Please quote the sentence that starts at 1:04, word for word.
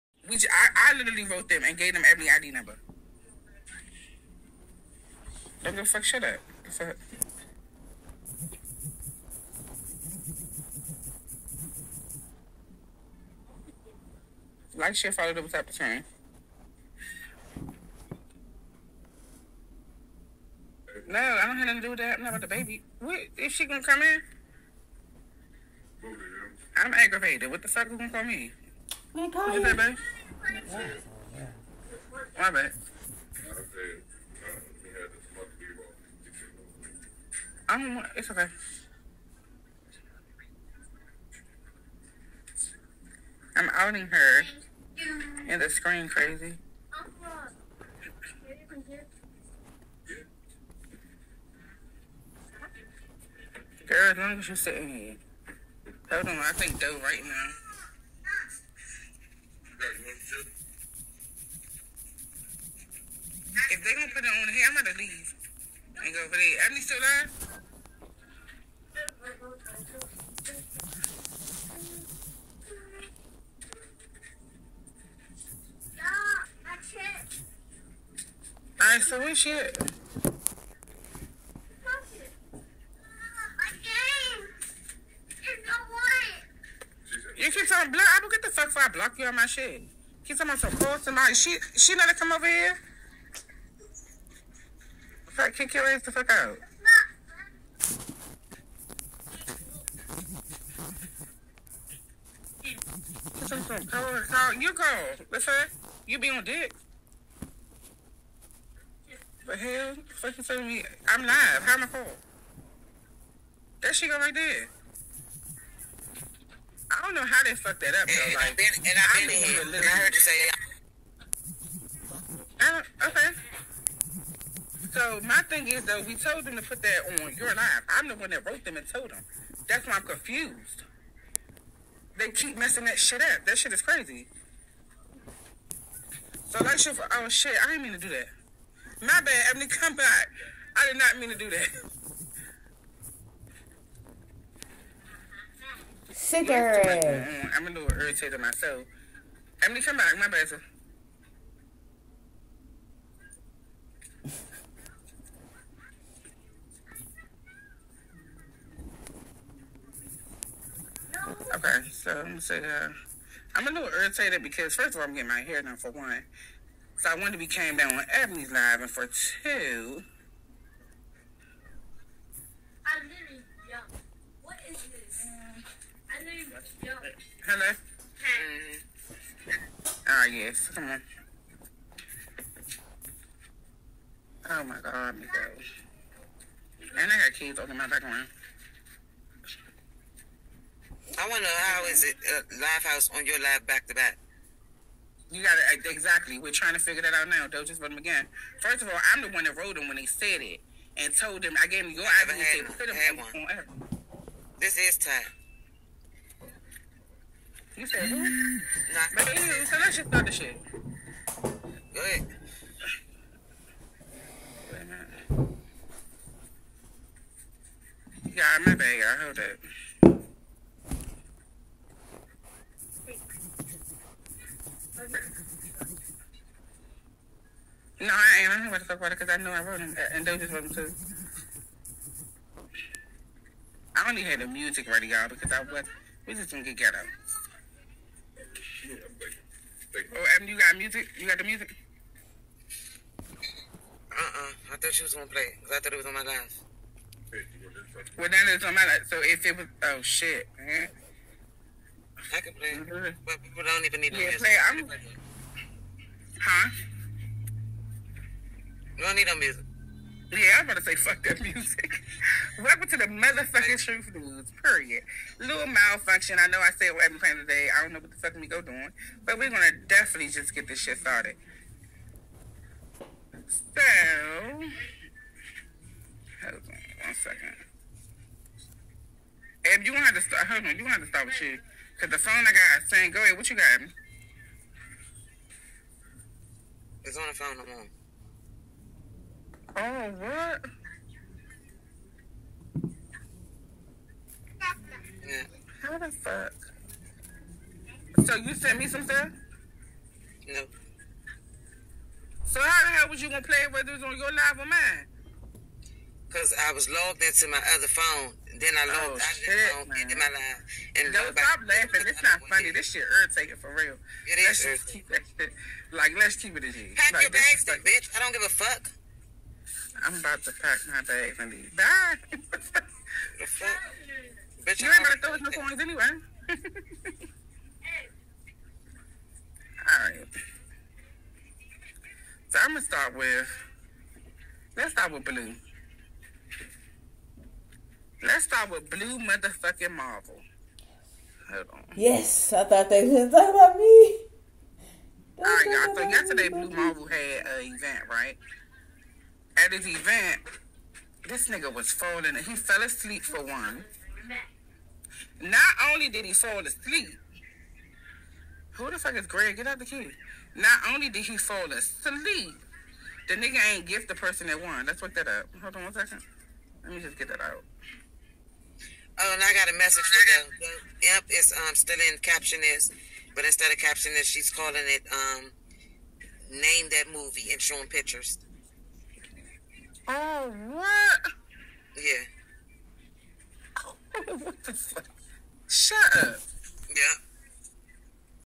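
I'm going to leave and go over there.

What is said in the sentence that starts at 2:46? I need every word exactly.
So I wanted to be came down on Ebony's live, and for two.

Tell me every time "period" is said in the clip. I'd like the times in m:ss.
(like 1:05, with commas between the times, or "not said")
4:24.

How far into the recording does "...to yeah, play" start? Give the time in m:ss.
4:14.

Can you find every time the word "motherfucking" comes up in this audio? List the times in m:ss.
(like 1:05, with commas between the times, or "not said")
4:23, 5:39.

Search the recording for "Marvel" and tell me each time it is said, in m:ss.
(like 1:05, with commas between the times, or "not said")
5:39, 5:46.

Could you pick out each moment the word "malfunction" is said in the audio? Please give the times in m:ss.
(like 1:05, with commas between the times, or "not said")
4:25.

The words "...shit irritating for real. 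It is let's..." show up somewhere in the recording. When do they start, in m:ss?
5:12.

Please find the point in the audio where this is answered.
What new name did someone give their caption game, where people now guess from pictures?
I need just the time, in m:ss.
6:16.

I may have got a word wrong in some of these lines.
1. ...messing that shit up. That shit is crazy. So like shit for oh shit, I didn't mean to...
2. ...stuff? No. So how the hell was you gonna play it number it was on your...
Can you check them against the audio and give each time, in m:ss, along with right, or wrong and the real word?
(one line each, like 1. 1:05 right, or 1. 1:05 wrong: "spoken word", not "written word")
1. 2:12 right
2. 4:59 wrong: "whether", not "number".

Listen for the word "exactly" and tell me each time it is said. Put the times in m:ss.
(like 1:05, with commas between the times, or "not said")
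3:15.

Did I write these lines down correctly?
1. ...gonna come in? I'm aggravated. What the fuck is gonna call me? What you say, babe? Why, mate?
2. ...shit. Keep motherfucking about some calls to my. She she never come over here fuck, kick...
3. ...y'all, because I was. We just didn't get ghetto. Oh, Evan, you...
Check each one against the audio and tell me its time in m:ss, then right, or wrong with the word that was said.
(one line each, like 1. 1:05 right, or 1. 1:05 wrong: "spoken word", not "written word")
1. 0:23 right
2. 1:29 wrong: "talking", not "motherfucking"
3. 3:55 right.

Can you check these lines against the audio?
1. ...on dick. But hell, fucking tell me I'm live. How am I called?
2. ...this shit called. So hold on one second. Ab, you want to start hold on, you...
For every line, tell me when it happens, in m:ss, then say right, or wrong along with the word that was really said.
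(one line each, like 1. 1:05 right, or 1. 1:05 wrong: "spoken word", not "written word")
1. 1:46 right
2. 4:30 wrong: "started", not "called".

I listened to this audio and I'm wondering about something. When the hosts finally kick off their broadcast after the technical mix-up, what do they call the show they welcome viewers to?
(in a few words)
Truth News.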